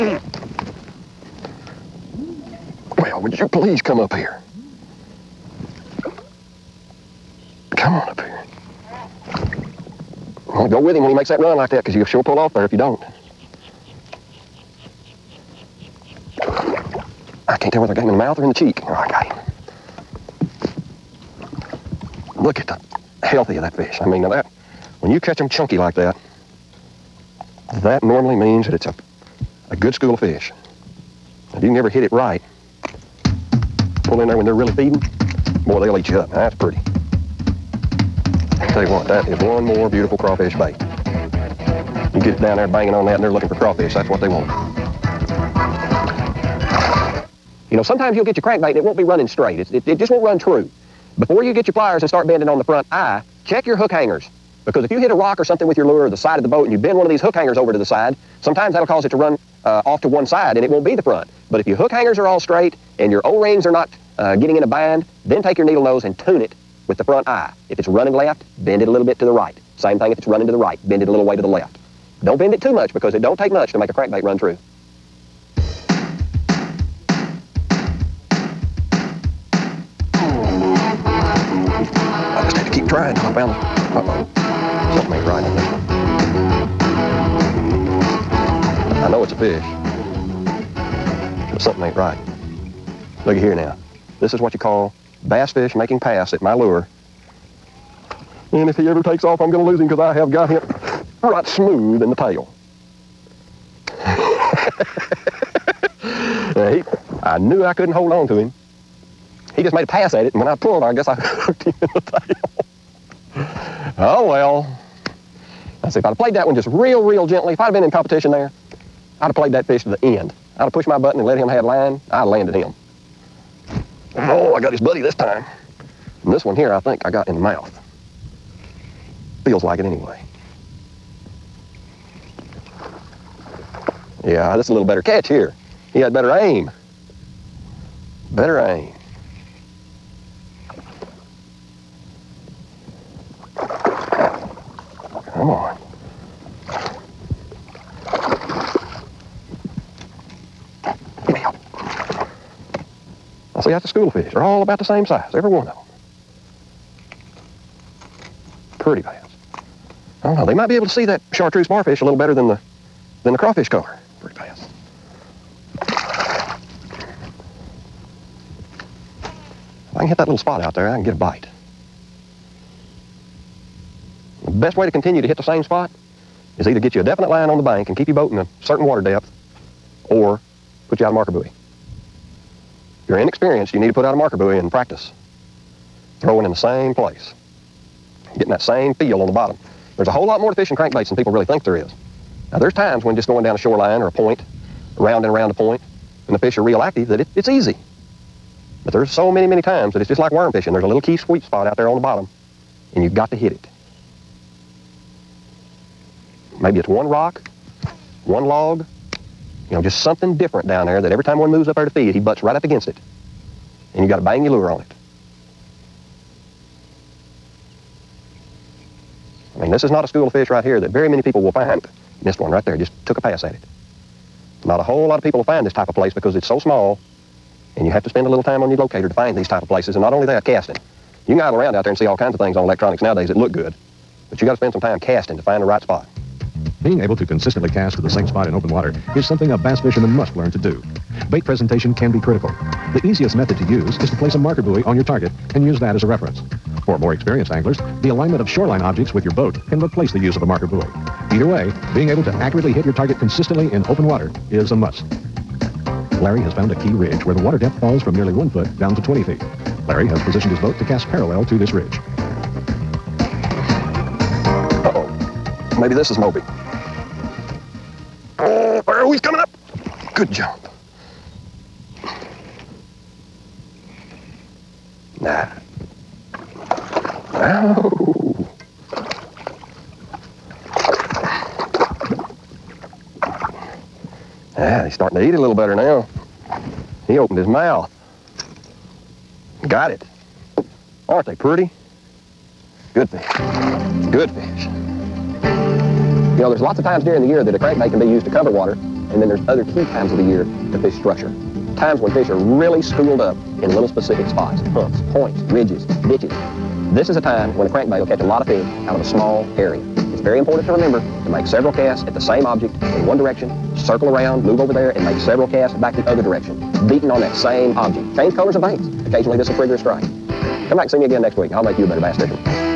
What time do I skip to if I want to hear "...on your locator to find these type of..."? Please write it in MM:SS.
03:48.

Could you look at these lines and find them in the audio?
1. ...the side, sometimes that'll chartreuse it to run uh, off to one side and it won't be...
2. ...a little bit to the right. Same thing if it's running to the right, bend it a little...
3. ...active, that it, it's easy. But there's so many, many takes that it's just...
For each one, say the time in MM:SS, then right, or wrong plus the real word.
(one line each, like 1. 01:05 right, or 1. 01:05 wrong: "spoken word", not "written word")
1. 00:57 wrong: "cause", not "chartreuse"
2. 01:08 right
3. 03:16 wrong: "times", not "takes".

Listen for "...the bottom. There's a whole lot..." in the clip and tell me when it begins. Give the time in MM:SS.
03:09.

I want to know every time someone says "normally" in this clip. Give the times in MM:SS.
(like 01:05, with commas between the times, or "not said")
00:28.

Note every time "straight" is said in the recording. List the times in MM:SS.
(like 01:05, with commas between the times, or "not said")
00:49, 01:02.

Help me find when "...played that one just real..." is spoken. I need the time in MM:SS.
01:56.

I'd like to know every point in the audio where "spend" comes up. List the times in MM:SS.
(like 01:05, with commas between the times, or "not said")
03:48, 03:54.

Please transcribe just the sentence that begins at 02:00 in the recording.
I'd have pushed my button and let him have line.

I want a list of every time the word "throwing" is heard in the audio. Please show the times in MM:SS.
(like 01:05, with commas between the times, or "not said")
03:06.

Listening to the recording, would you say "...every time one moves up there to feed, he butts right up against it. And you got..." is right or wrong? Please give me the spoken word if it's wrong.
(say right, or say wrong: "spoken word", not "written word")
right.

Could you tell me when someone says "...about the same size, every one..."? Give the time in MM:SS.
02:34.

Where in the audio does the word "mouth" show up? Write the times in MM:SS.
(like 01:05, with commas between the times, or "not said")
00:18, 02:07, 04:47.